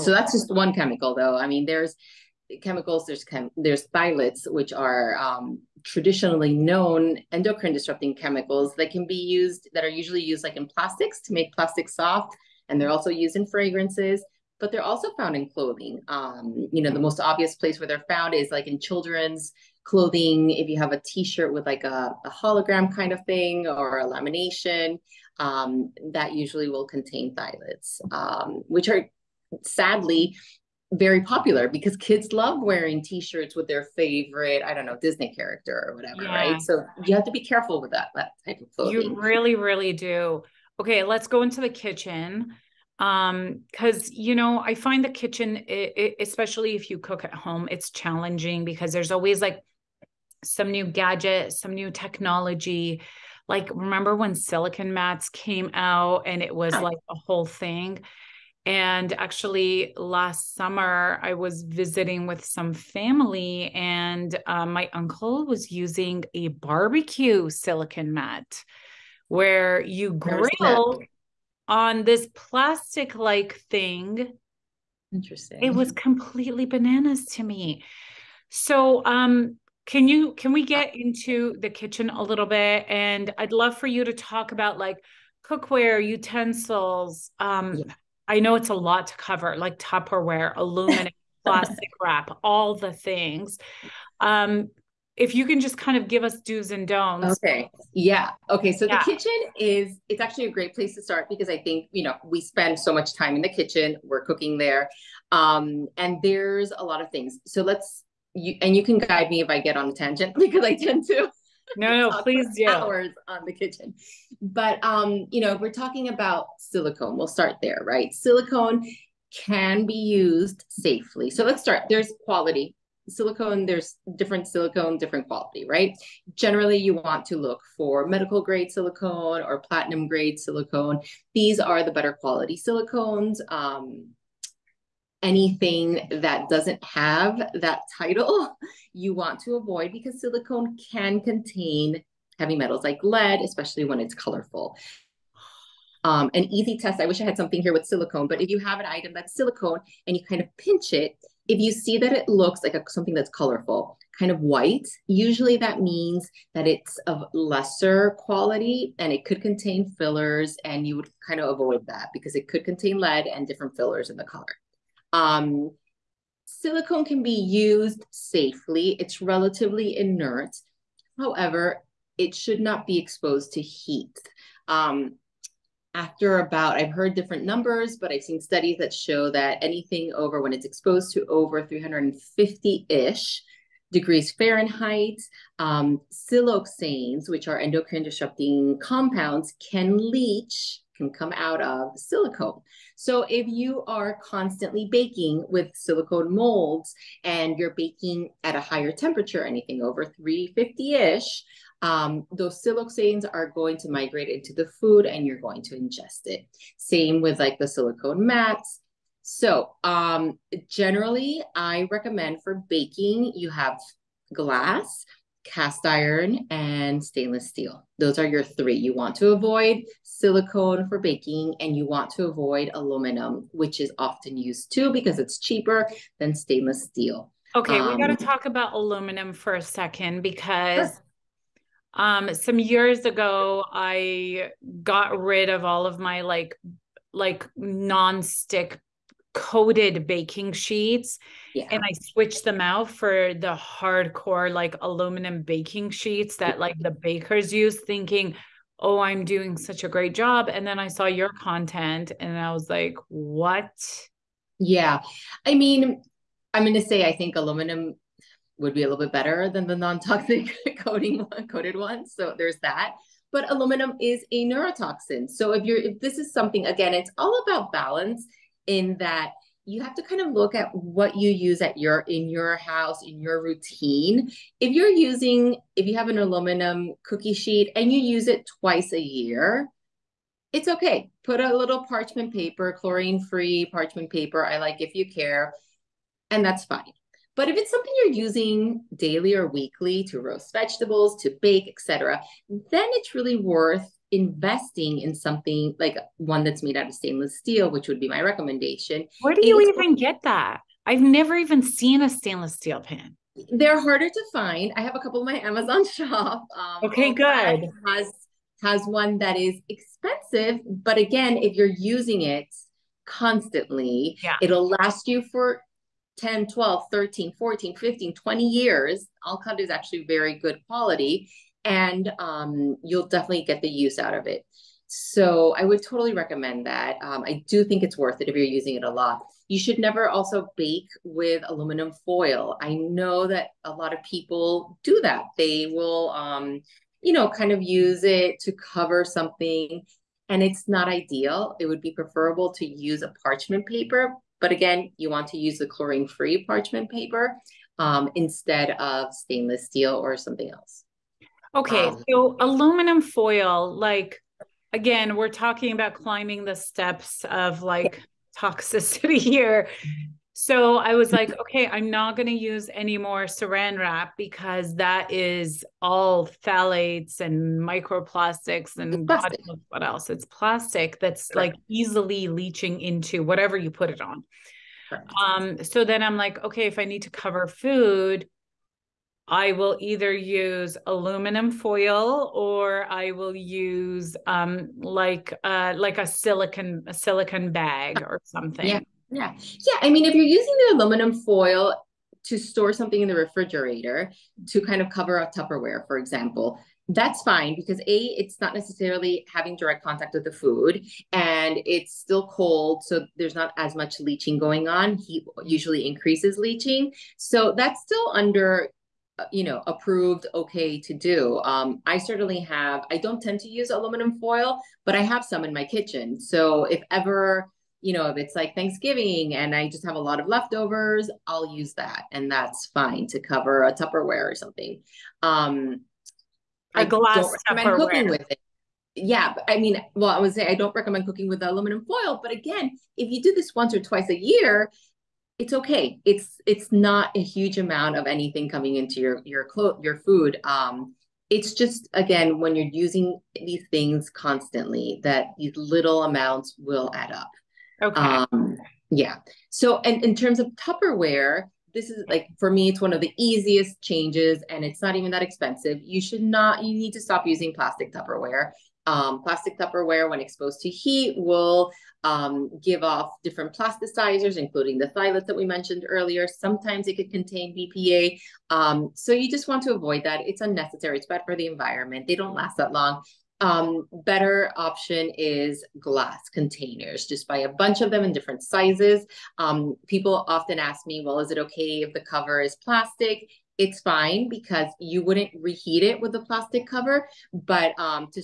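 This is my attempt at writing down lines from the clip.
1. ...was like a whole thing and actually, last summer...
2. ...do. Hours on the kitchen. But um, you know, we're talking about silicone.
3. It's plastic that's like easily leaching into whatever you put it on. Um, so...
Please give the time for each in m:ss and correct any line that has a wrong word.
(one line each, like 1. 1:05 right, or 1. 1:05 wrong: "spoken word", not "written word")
1. 0:56 right
2. 1:52 right
3. 6:10 right.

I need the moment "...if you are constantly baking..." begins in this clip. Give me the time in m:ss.
3:13.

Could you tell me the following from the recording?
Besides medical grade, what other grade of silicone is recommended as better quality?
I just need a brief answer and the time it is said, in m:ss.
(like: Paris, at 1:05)
platinum grade, at 2:09.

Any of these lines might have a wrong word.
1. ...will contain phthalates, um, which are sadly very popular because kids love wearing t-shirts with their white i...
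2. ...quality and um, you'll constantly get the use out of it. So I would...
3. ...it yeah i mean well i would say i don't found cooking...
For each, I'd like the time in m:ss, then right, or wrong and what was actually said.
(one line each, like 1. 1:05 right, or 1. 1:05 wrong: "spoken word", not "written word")
1. 0:26 wrong: "favorite", not "white"
2. 5:20 wrong: "definitely", not "constantly"
3. 7:08 wrong: "recommend", not "found".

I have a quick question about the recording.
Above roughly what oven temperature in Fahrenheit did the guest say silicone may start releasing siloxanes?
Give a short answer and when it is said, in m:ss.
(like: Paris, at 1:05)
350, at 3:01.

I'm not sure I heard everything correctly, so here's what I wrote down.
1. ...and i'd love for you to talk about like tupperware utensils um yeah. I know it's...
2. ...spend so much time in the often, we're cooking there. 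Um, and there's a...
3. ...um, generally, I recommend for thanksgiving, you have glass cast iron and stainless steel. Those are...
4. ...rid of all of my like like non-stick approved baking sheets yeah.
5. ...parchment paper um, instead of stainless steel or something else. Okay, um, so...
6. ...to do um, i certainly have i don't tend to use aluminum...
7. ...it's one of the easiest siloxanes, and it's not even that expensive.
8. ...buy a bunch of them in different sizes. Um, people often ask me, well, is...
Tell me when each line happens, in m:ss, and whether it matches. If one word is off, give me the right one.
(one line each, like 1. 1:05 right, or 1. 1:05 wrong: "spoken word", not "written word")
1. 1:22 wrong: "cookware", not "tupperware"
2. 1:42 wrong: "kitchen", not "often"
3. 3:29 wrong: "baking", not "thanksgiving"
4. 3:55 wrong: "coated", not "approved"
5. 5:46 right
6. 6:50 right
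7. 7:32 wrong: "changes", not "siloxanes"
8. 7:57 right.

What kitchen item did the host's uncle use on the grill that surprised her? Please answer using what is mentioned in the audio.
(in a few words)
silicon mat.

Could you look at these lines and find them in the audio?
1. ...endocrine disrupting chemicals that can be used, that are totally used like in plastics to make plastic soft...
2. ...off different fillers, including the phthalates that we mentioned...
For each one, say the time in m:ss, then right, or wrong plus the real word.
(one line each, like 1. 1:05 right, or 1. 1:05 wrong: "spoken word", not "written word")
1. 0:07 wrong: "usually", not "totally"
2. 7:42 wrong: "plasticizers", not "fillers".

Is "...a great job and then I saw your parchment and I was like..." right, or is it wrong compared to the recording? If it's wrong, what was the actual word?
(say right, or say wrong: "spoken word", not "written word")
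wrong: "content", not "parchment".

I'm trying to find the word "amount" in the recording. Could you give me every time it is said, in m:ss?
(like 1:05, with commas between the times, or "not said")
7:17, 7:26.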